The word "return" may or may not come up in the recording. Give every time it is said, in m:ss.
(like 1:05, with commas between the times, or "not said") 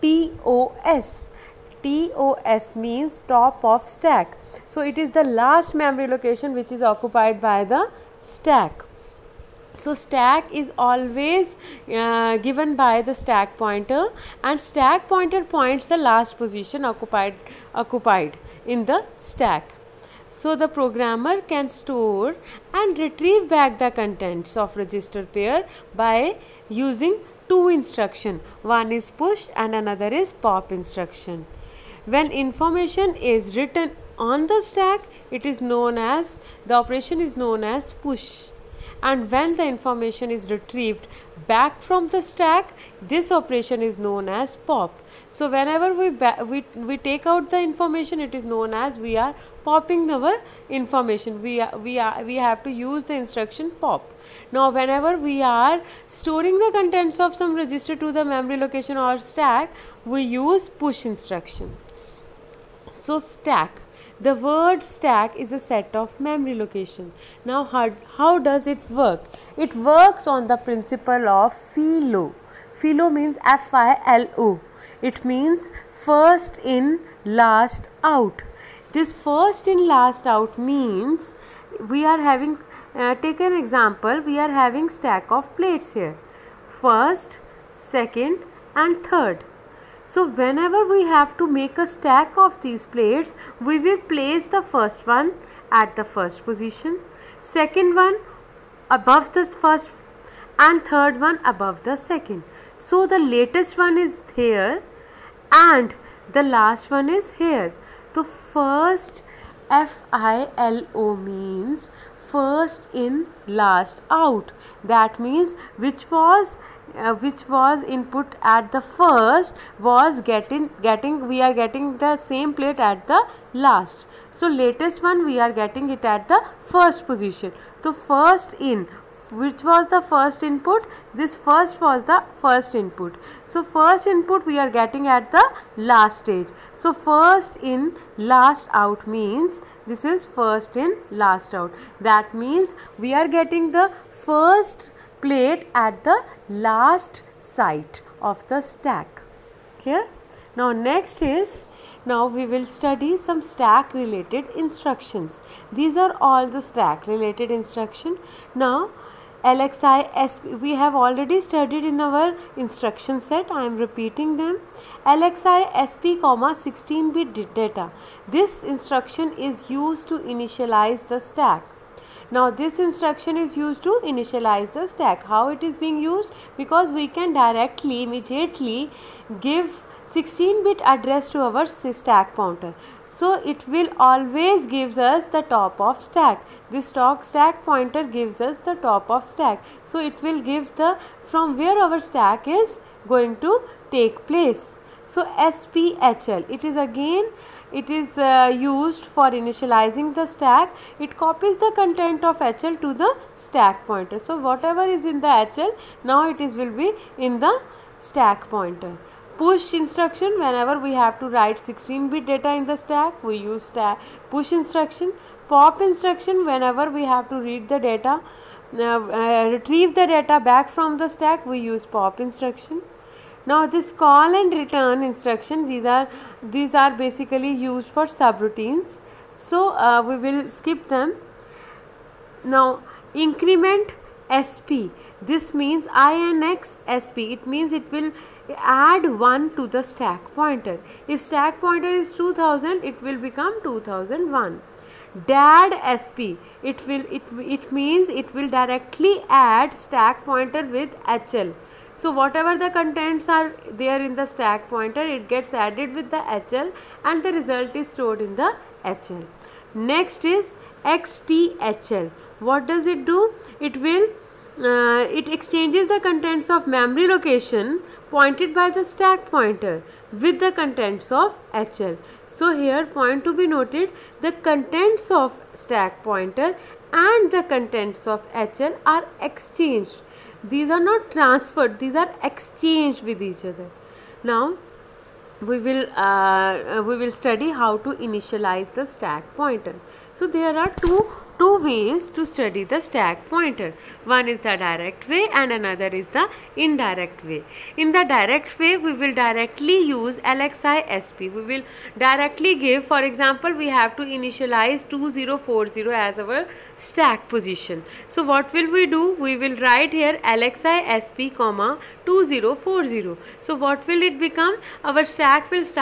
3:44.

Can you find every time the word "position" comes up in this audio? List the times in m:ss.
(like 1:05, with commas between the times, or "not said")
0:16, 1:36, 2:07, 5:07.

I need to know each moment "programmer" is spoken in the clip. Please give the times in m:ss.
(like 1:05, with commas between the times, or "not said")
0:20.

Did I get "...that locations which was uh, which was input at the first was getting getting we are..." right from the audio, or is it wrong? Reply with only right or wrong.
wrong.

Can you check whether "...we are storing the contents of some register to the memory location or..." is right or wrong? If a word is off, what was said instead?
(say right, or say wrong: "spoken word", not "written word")
right.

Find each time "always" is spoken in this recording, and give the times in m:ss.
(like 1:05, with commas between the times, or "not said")
0:10, 3:03.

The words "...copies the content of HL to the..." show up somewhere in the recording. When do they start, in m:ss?
3:21.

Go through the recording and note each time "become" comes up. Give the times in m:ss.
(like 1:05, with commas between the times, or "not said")
4:03, 5:14.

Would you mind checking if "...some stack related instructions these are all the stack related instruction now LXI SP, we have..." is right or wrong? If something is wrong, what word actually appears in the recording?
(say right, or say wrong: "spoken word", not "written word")
right.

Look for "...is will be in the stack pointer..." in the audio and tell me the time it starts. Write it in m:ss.
3:26.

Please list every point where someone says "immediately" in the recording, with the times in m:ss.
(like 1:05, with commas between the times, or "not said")
2:58.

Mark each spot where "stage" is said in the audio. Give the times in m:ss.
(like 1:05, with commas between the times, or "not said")
2:16.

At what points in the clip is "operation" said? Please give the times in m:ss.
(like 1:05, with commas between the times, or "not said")
0:36, 0:43.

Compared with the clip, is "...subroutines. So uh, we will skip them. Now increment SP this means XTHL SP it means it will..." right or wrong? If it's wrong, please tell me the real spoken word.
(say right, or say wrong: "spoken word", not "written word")
wrong: "INX", not "XTHL".